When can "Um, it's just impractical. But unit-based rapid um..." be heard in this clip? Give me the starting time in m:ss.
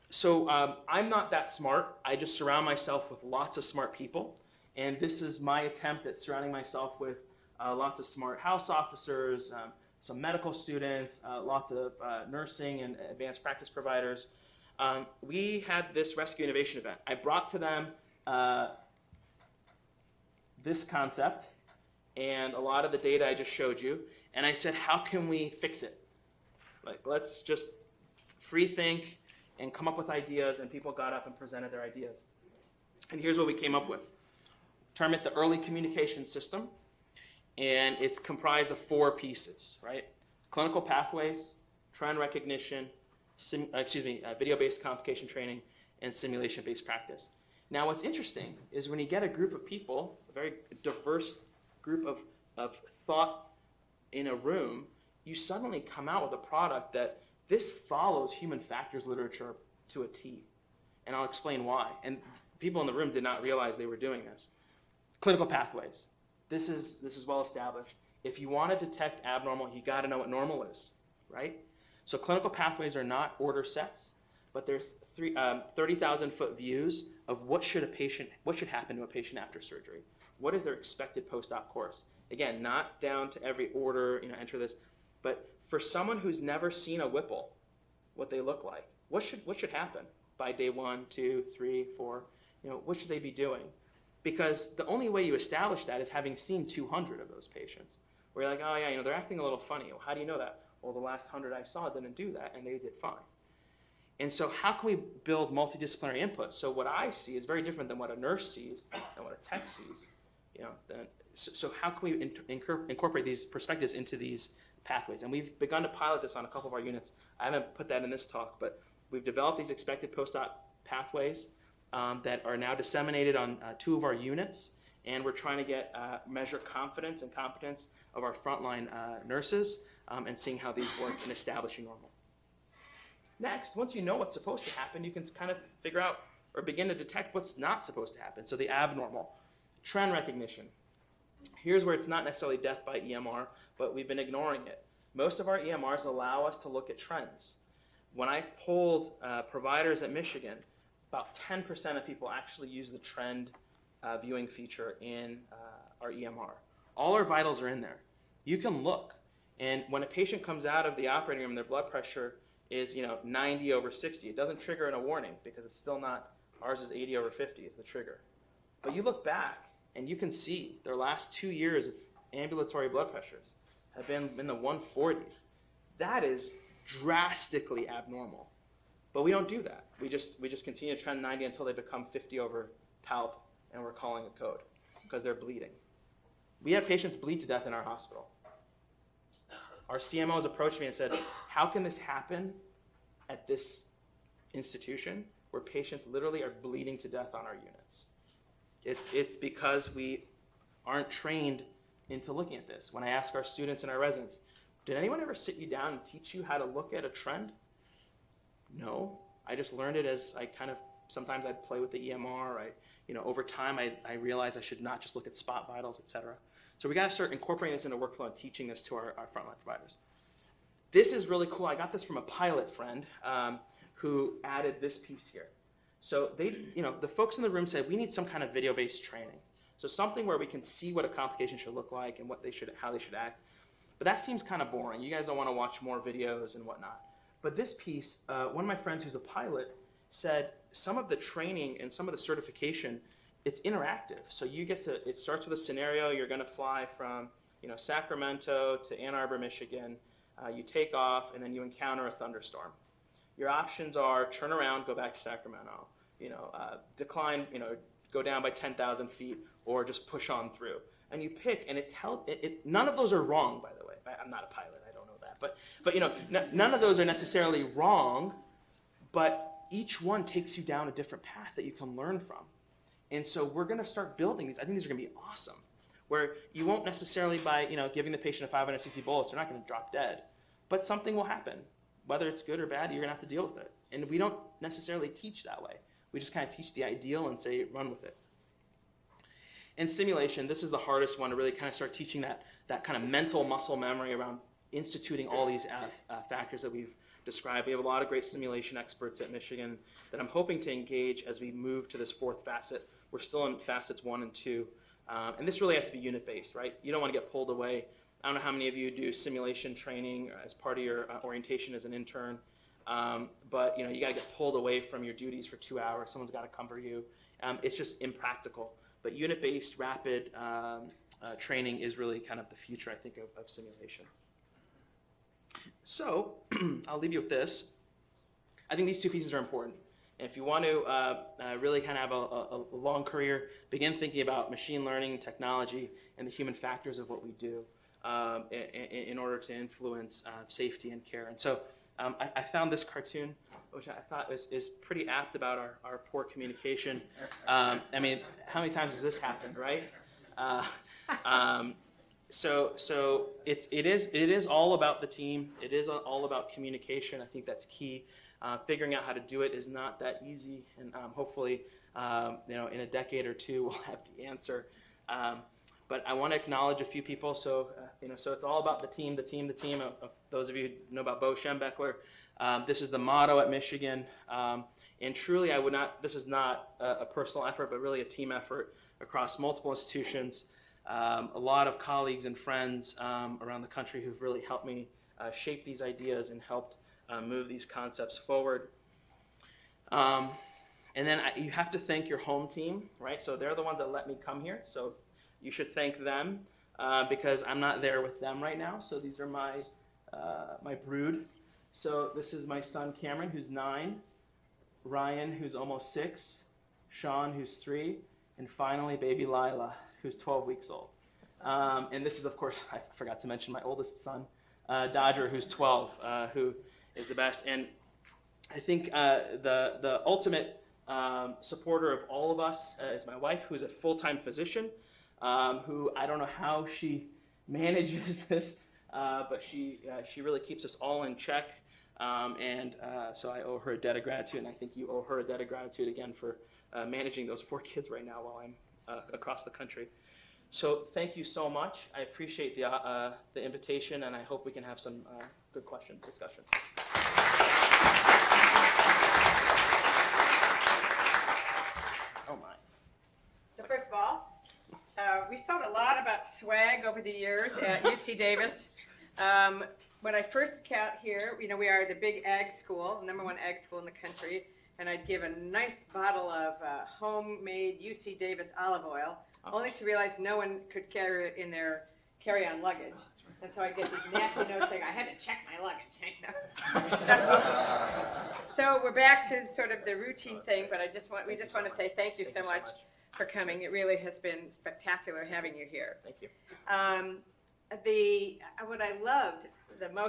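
5:17.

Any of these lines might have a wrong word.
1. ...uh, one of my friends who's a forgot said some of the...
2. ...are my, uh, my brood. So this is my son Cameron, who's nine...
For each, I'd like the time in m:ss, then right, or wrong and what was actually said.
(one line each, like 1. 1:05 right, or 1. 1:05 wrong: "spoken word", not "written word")
1. 3:58 wrong: "pilot", not "forgot"
2. 6:39 right.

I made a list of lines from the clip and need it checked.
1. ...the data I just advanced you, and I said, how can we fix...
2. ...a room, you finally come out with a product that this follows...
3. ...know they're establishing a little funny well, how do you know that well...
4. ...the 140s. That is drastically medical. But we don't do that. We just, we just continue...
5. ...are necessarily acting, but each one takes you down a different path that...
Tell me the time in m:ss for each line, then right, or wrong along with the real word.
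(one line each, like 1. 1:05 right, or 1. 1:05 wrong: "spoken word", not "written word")
1. 0:22 wrong: "showed", not "advanced"
2. 0:54 wrong: "suddenly", not "finally"
3. 1:38 wrong: "acting", not "establishing"
4. 2:54 wrong: "abnormal", not "medical"
5. 4:26 wrong: "wrong", not "acting".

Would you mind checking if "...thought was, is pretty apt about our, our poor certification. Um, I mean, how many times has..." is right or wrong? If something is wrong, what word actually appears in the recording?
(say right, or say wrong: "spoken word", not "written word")
wrong: "communication", not "certification".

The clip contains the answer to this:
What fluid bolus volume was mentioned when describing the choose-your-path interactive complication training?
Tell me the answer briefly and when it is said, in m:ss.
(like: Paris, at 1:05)
500 cc, at 4:38.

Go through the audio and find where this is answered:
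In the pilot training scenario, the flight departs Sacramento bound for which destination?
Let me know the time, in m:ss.
4:09.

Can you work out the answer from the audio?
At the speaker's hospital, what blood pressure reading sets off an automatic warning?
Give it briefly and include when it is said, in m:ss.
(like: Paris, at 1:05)
80 over 50, at 2:46.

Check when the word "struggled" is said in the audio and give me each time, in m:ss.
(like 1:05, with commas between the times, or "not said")
not said.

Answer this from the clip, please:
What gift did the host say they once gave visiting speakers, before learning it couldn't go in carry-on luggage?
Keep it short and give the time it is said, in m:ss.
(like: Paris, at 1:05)
Olive oil, at 7:48.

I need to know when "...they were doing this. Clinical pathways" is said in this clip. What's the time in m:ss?
1:03.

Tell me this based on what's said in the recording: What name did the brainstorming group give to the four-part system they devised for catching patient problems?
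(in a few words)
Early communication system.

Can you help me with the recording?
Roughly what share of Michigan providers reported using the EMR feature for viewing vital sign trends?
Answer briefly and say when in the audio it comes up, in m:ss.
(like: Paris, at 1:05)
10%, at 2:31.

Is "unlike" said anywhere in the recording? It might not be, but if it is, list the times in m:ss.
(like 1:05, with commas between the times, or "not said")
not said.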